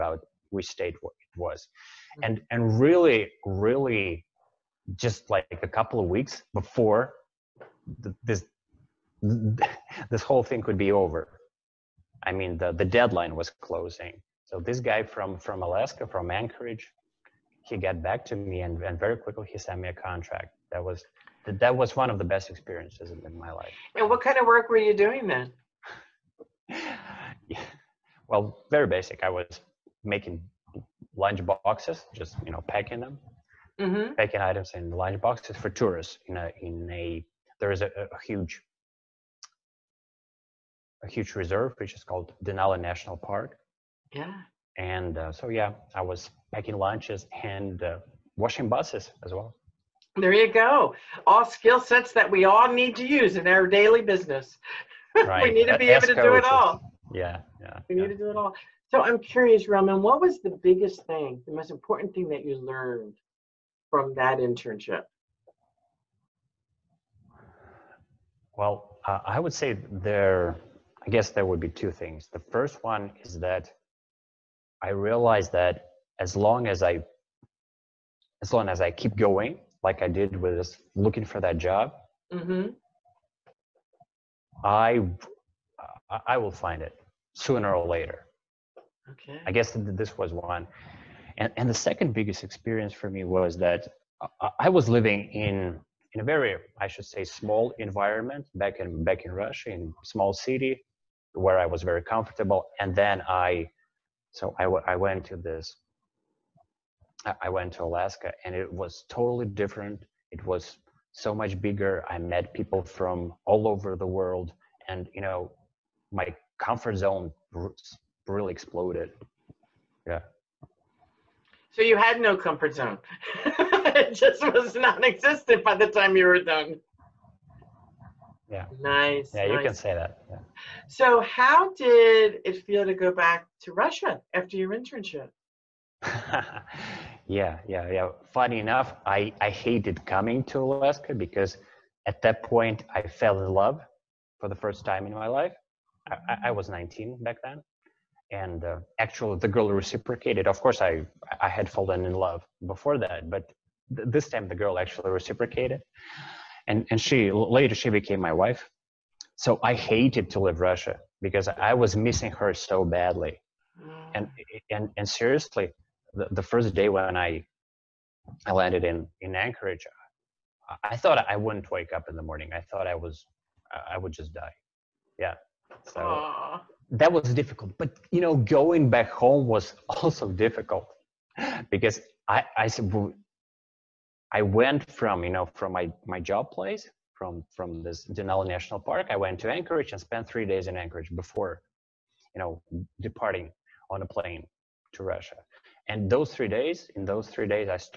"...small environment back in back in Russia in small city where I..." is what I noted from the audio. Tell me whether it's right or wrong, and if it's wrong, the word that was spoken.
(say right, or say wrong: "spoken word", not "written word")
right.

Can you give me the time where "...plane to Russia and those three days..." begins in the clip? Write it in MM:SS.
03:14.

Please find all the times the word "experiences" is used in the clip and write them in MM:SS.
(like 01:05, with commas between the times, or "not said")
00:22, 01:32.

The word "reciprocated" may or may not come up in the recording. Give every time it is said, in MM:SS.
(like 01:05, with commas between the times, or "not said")
02:29, 02:35.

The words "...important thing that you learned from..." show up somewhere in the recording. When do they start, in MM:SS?
01:01.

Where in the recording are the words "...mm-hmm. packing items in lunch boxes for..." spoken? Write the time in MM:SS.
00:33.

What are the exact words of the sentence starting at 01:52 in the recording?
I met people from all over the world and, you know, my comfort zone really exploded.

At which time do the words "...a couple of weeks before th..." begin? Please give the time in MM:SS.
00:05.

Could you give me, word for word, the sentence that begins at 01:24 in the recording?
I I will find it sooner or later.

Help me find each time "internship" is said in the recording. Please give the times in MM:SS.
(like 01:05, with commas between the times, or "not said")
01:04, 02:14.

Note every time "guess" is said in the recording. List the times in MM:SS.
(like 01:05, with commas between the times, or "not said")
01:11, 01:29.